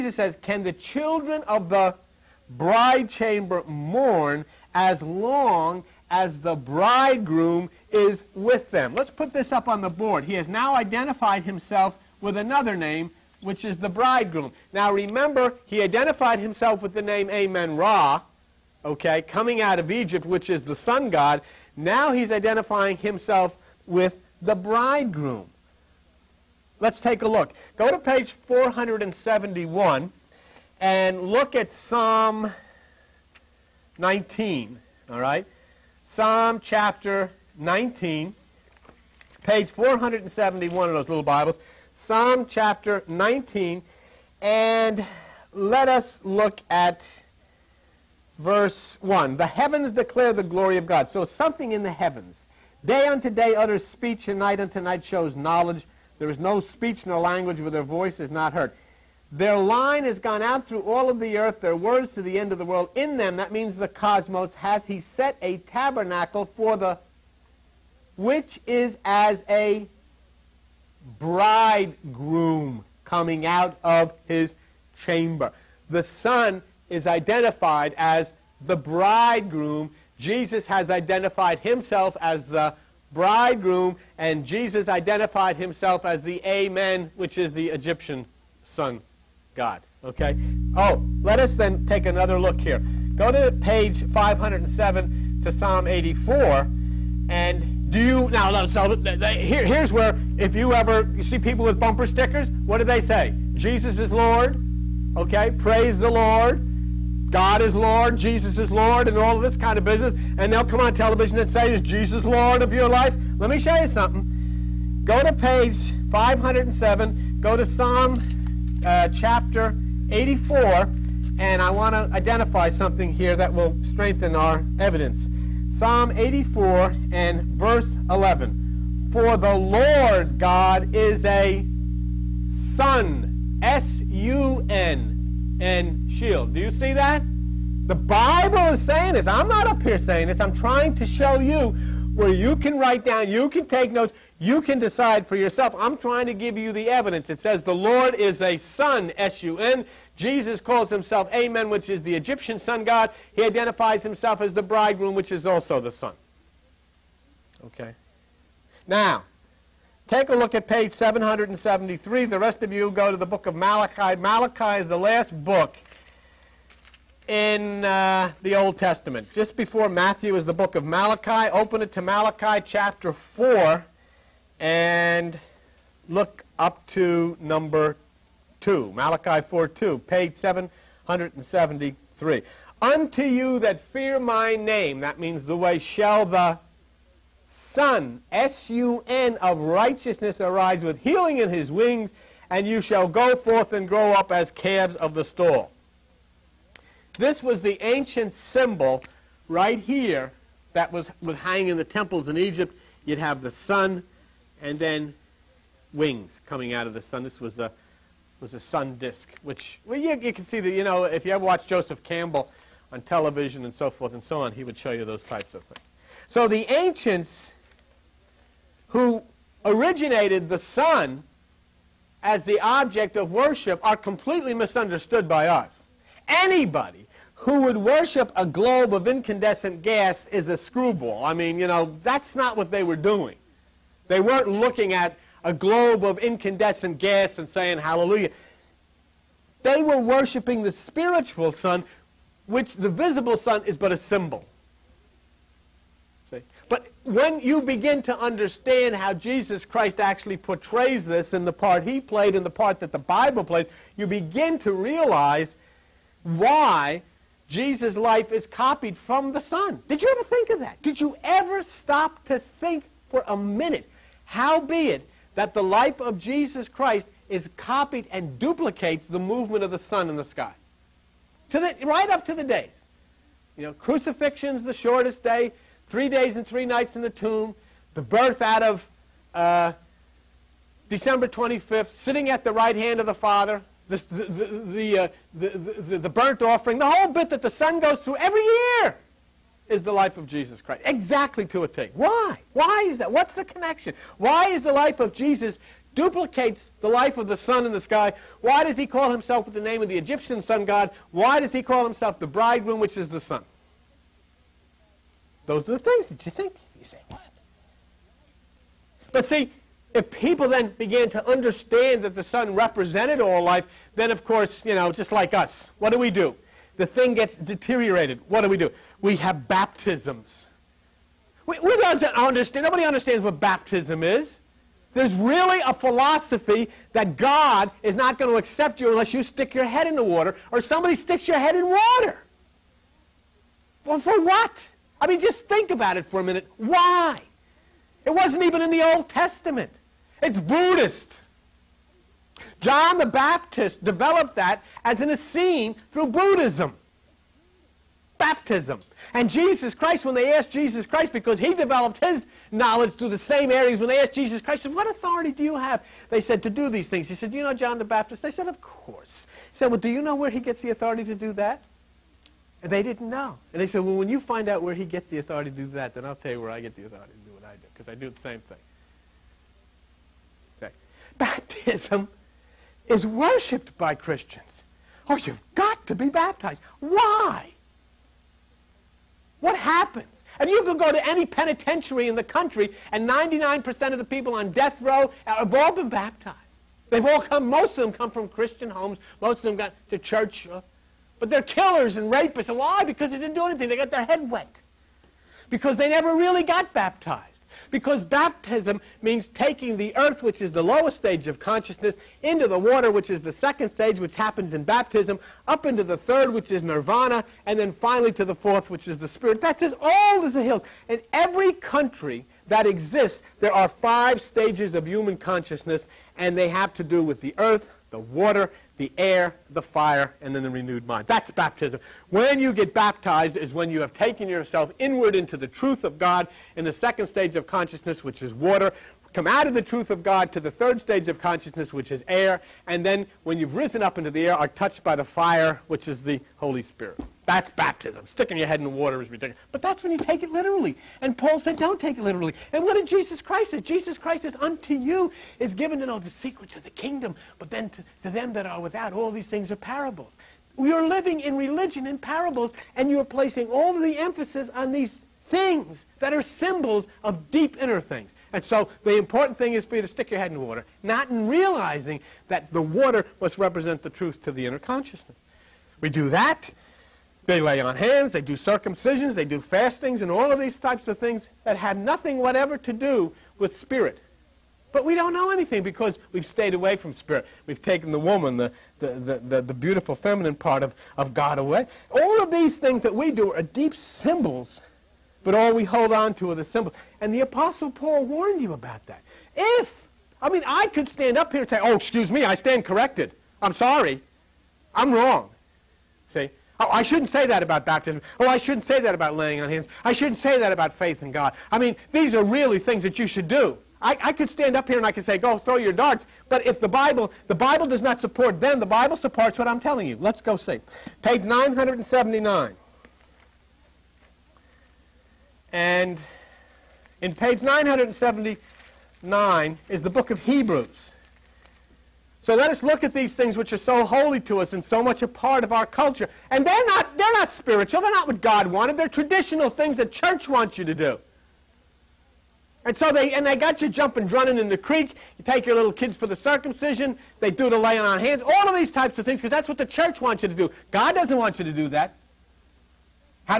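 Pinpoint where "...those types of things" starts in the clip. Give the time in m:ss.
3:35.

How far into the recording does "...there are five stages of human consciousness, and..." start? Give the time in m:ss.
6:53.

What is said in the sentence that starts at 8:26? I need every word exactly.
But if the Bible, the Bible does not support them, the Bible supports what I'm telling you.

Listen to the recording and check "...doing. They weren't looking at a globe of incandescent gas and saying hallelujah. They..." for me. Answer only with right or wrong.
right.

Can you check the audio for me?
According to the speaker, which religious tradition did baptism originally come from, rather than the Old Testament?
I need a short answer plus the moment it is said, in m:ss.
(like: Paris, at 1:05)
Buddhism, at 5:40.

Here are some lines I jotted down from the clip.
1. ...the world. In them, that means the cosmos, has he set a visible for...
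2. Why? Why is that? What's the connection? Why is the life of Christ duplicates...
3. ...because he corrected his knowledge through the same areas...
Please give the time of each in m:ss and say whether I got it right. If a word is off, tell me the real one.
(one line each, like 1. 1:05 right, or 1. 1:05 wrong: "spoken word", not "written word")
1. 1:02 wrong: "tabernacle", not "visible"
2. 4:51 wrong: "Jesus", not "Christ"
3. 5:51 wrong: "developed", not "corrected".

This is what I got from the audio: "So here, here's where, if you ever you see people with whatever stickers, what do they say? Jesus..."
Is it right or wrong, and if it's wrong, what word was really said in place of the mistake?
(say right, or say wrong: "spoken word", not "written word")
wrong: "bumper", not "whatever".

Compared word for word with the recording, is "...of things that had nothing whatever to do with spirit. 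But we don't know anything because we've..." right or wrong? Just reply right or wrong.
right.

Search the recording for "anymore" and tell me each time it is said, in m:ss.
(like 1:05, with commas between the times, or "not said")
not said.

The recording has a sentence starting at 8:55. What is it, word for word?
You take your little kids for the circumcision.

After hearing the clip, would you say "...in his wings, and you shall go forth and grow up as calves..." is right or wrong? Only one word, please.
right.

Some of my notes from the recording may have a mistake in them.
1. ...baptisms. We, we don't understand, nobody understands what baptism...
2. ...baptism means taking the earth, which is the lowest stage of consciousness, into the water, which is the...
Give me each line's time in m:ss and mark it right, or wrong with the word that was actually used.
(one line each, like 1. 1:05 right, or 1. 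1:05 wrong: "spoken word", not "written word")
1. 5:19 right
2. 6:38 right.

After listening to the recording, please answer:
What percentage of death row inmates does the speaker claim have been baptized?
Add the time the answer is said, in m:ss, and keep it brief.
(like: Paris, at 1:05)
99%, at 6:23.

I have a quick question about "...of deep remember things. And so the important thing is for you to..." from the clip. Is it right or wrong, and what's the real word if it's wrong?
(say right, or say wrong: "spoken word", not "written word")
wrong: "inner", not "remember".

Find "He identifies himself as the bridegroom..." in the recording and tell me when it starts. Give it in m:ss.
2:33.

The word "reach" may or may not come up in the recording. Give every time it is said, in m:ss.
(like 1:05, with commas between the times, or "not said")
not said.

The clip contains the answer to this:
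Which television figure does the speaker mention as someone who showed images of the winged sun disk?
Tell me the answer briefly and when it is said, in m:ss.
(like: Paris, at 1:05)
Joseph Campbell, at 3:31.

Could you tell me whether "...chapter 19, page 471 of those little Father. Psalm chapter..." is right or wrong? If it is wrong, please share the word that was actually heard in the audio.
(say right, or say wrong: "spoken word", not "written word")
wrong: "Bibles", not "Father".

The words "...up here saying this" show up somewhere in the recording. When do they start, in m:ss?
2:19.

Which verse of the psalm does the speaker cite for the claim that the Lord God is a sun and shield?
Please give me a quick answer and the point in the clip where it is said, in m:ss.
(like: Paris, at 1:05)
verse 11, at 2:07.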